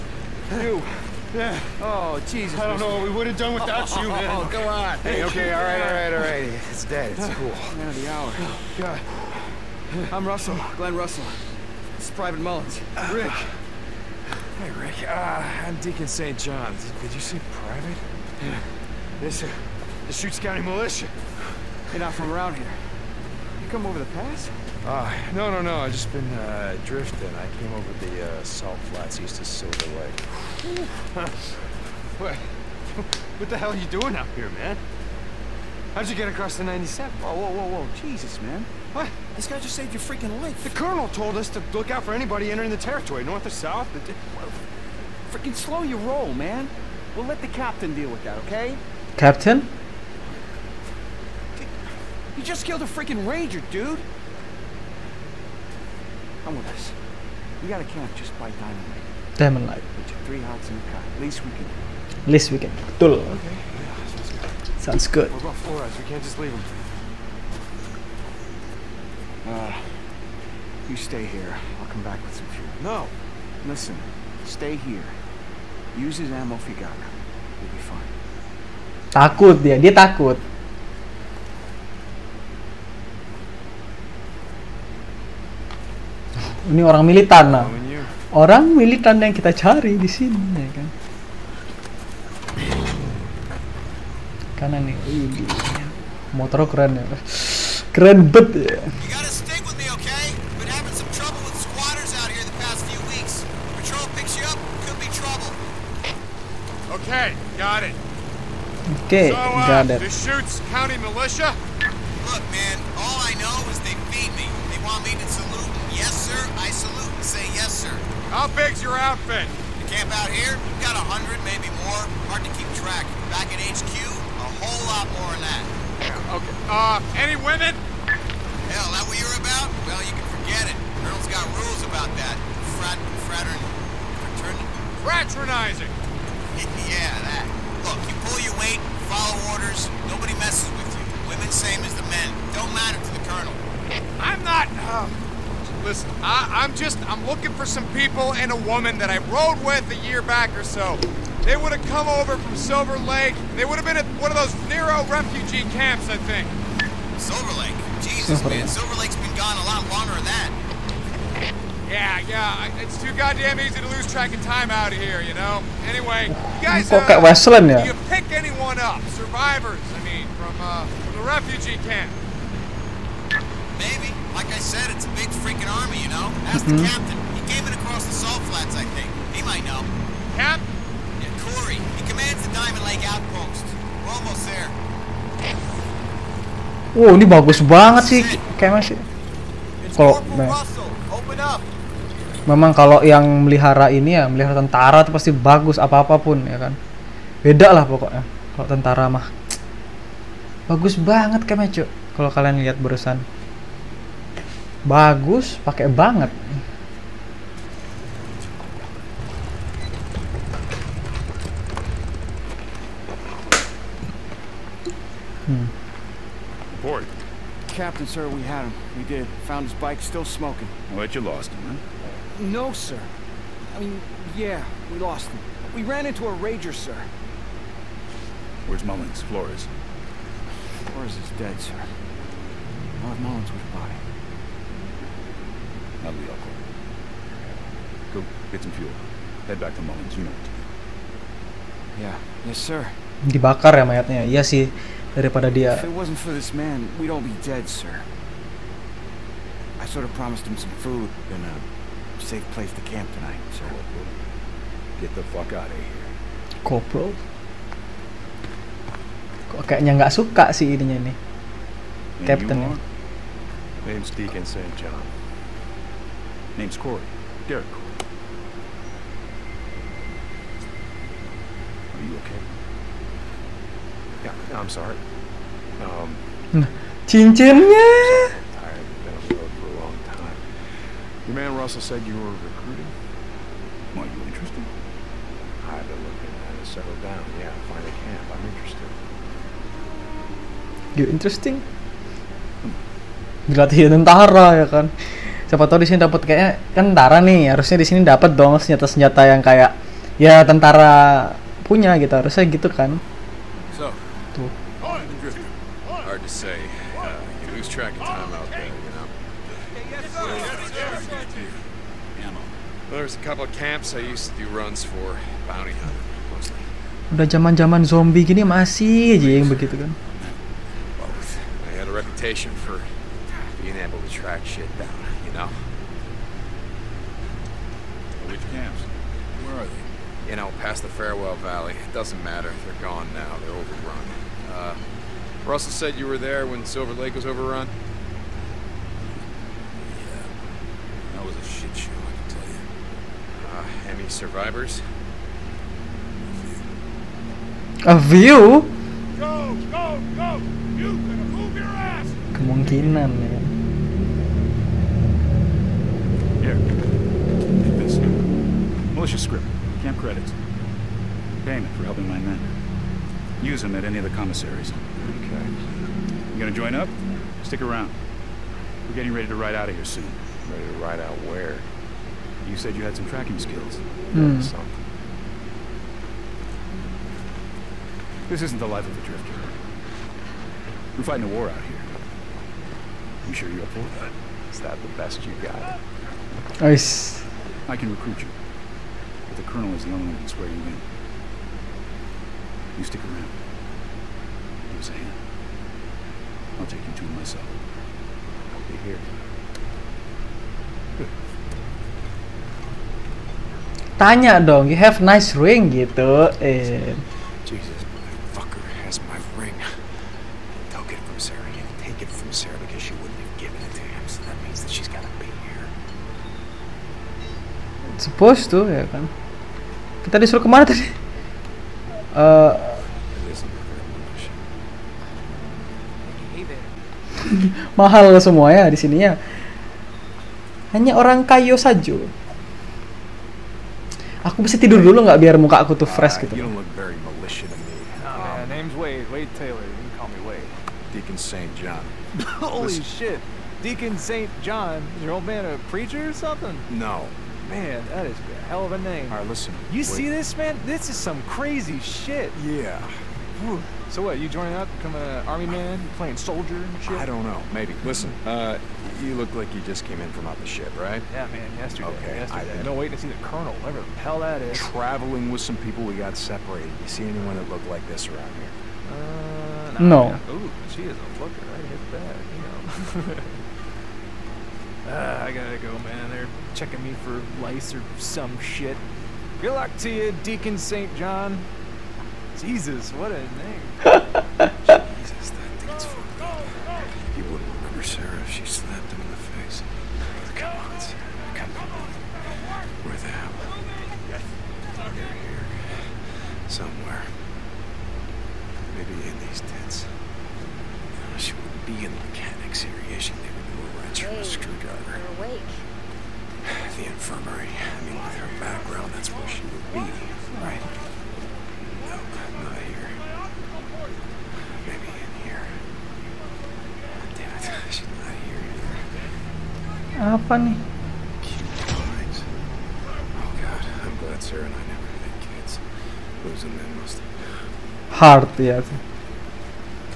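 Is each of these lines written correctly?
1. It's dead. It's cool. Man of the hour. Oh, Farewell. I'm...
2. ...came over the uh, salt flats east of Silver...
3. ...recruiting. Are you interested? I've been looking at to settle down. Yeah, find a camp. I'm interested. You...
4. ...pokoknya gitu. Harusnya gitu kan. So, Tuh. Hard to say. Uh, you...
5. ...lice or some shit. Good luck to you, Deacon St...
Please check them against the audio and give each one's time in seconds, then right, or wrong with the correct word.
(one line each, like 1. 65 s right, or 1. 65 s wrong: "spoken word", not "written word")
1. 6 s wrong: "God", not "Farewell"
2. 27 s right
3. 282 s right
4. 301 s wrong: "punya", not "pokoknya"
5. 477 s right.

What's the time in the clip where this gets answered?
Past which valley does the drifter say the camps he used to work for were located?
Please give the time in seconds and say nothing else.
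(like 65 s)
330 s.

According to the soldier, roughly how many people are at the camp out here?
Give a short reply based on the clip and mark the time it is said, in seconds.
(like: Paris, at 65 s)
100, at 120 s.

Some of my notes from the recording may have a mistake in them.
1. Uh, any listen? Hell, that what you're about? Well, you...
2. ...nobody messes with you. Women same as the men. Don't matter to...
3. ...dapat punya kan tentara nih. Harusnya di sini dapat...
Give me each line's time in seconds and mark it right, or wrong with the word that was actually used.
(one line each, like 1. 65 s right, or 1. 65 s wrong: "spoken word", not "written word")
1. 126 s wrong: "women", not "listen"
2. 140 s right
3. 296 s wrong: "kayaknya", not "punya".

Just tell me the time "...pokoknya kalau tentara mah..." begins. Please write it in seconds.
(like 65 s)
197 s.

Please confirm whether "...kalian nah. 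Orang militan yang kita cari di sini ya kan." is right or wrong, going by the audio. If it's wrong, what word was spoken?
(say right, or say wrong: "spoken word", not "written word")
wrong: "militan", not "kalian".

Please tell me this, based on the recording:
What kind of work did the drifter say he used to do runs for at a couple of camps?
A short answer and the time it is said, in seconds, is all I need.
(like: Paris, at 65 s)
bounty hunting, at 315 s.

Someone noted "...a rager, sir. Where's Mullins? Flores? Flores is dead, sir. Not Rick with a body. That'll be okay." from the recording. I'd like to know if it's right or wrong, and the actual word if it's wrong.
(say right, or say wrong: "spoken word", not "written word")
wrong: "Mullins", not "Rick".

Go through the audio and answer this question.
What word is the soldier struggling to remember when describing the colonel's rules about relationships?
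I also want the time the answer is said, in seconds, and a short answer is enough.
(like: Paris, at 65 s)
Fraternizing, at 135 s.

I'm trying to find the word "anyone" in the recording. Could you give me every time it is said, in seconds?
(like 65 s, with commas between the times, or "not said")
168 s, 467 s.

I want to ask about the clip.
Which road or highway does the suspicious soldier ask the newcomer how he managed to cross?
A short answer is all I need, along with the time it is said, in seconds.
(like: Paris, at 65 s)
the 97, at 36 s.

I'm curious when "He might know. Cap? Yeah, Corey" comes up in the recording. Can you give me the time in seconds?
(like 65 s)
179 s.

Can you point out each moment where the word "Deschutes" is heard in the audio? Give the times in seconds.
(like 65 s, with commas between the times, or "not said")
20 s, 110 s.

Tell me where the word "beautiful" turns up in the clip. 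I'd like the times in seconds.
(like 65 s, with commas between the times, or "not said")
not said.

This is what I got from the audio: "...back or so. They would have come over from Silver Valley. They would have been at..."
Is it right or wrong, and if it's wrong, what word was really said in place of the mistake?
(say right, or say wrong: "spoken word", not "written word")
wrong: "Lake", not "Valley".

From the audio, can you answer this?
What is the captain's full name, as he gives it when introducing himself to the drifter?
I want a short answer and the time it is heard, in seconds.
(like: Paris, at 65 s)
Derek Corey, at 267 s.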